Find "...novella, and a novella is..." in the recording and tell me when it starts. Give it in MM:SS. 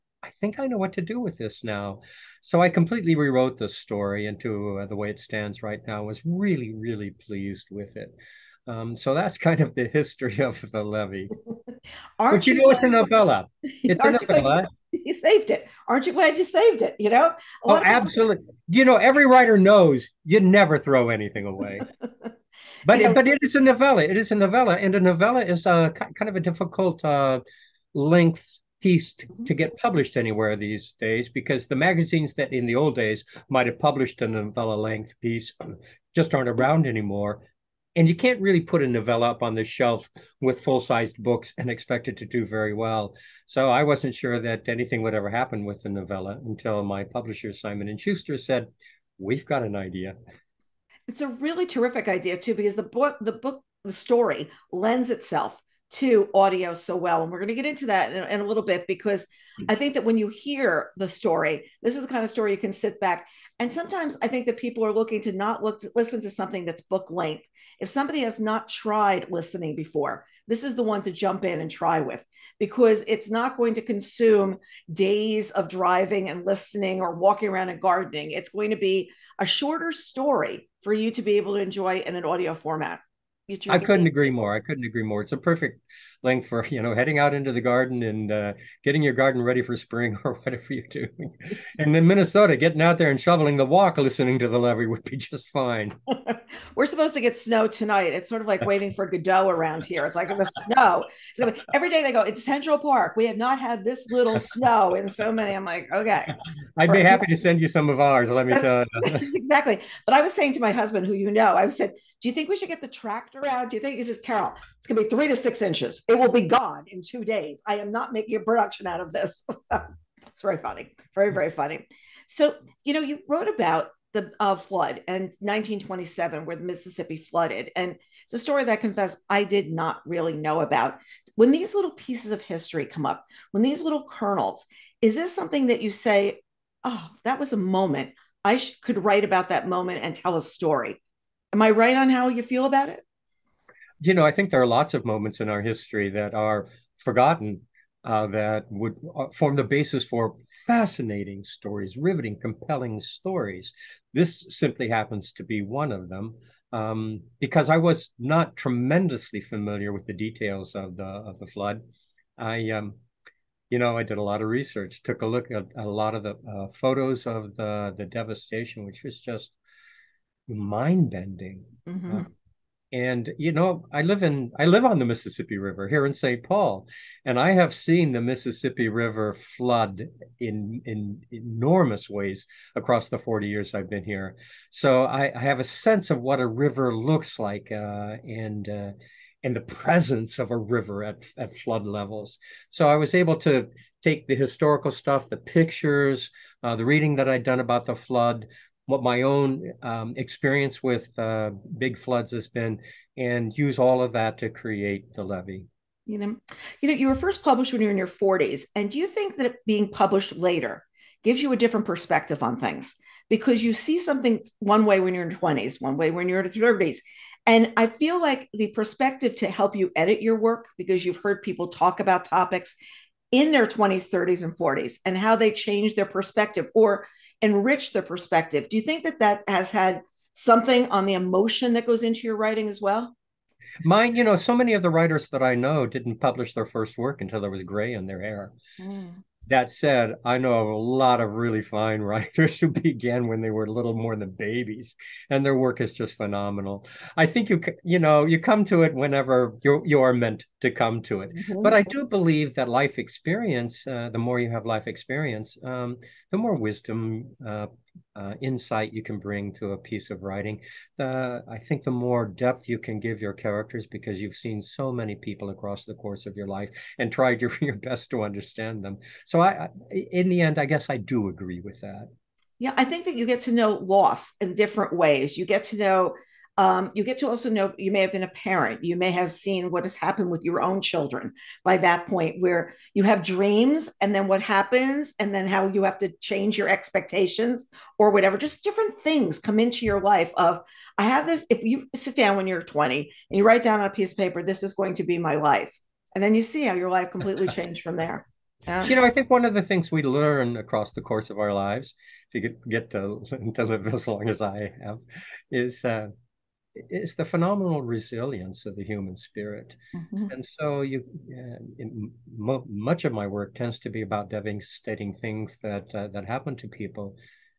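00:24.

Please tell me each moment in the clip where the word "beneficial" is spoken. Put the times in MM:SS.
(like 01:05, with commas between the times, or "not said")
not said.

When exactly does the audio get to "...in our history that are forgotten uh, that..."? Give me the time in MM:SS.
02:25.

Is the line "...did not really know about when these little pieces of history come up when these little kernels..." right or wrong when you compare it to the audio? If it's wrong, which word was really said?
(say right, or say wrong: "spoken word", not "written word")
right.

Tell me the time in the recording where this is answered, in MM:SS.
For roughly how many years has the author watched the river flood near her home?
03:03.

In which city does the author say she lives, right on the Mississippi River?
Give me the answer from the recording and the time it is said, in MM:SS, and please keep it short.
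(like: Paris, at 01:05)
St. Paul, at 02:56.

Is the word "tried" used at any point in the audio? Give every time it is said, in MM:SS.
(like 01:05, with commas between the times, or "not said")
01:08, 04:27.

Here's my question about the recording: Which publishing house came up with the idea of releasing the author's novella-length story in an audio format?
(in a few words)
Simon and Schuster.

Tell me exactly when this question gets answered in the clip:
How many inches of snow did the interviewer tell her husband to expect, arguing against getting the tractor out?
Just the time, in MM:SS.
01:55.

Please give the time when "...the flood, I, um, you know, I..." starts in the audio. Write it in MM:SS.
02:41.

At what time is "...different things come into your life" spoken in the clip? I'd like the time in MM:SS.
04:48.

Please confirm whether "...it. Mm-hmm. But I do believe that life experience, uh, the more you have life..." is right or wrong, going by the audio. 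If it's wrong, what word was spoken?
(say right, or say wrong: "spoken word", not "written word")
right.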